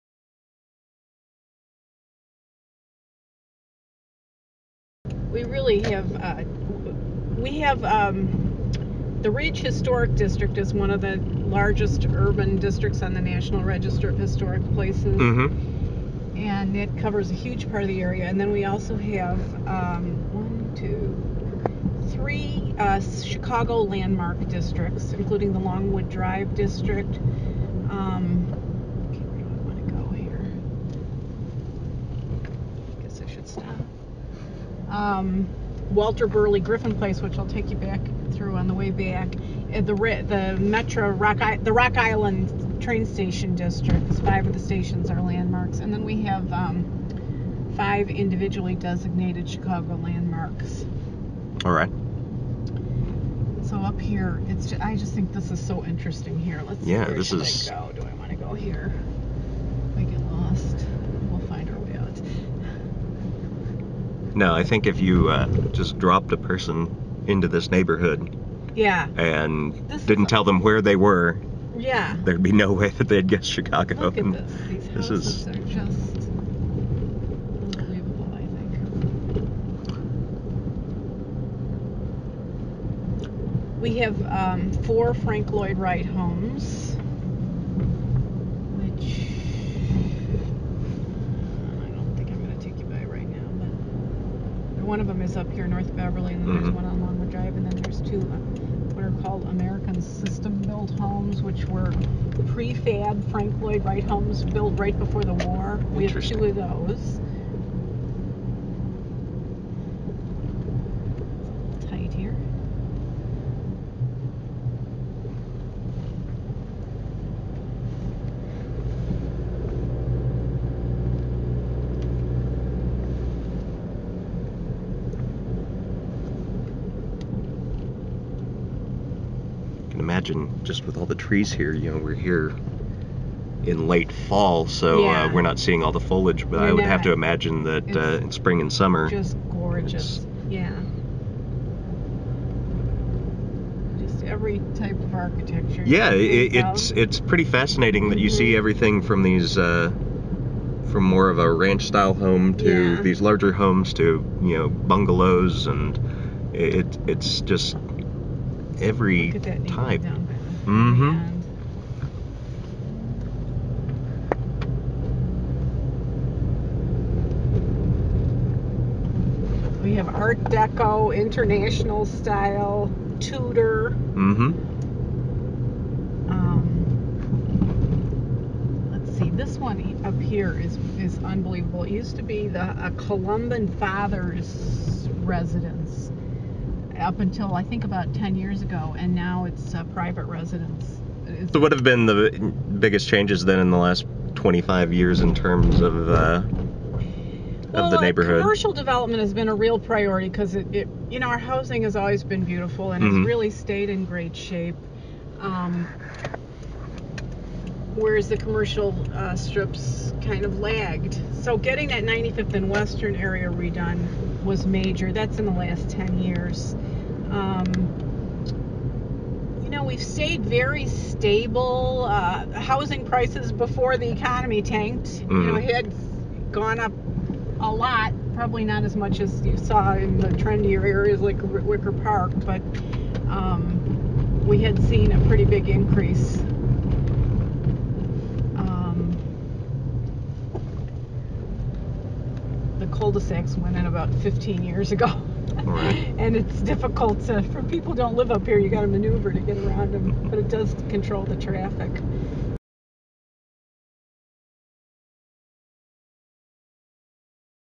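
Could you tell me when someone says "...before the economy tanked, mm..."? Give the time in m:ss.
3:43.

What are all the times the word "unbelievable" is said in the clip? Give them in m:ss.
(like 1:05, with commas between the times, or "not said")
1:17, 3:01.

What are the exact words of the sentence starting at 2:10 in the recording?
imagine just with all the trees here, you know, we're here in late fall, so uh, yeah.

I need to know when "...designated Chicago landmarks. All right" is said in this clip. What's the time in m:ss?
0:48.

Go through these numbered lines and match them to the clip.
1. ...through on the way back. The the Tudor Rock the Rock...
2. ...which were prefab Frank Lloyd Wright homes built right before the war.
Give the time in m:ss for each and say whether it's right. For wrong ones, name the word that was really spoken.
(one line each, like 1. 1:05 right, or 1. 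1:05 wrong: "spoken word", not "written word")
1. 0:38 wrong: "Metra", not "Tudor"
2. 1:41 right.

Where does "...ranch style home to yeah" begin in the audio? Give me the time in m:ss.
2:31.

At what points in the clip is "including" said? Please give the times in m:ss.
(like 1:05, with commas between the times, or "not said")
0:25.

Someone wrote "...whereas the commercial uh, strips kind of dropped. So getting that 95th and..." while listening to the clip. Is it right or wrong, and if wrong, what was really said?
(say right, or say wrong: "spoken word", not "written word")
wrong: "lagged", not "dropped".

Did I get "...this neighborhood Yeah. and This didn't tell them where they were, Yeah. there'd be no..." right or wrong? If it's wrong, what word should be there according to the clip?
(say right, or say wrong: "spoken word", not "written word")
right.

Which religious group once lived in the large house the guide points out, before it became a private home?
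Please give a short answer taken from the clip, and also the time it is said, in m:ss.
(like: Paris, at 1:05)
Columban Fathers, at 3:02.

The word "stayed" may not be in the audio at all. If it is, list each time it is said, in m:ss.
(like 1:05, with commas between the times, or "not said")
3:23, 3:40.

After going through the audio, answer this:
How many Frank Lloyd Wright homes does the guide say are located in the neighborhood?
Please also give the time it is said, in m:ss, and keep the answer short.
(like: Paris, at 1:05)
4, at 1:24.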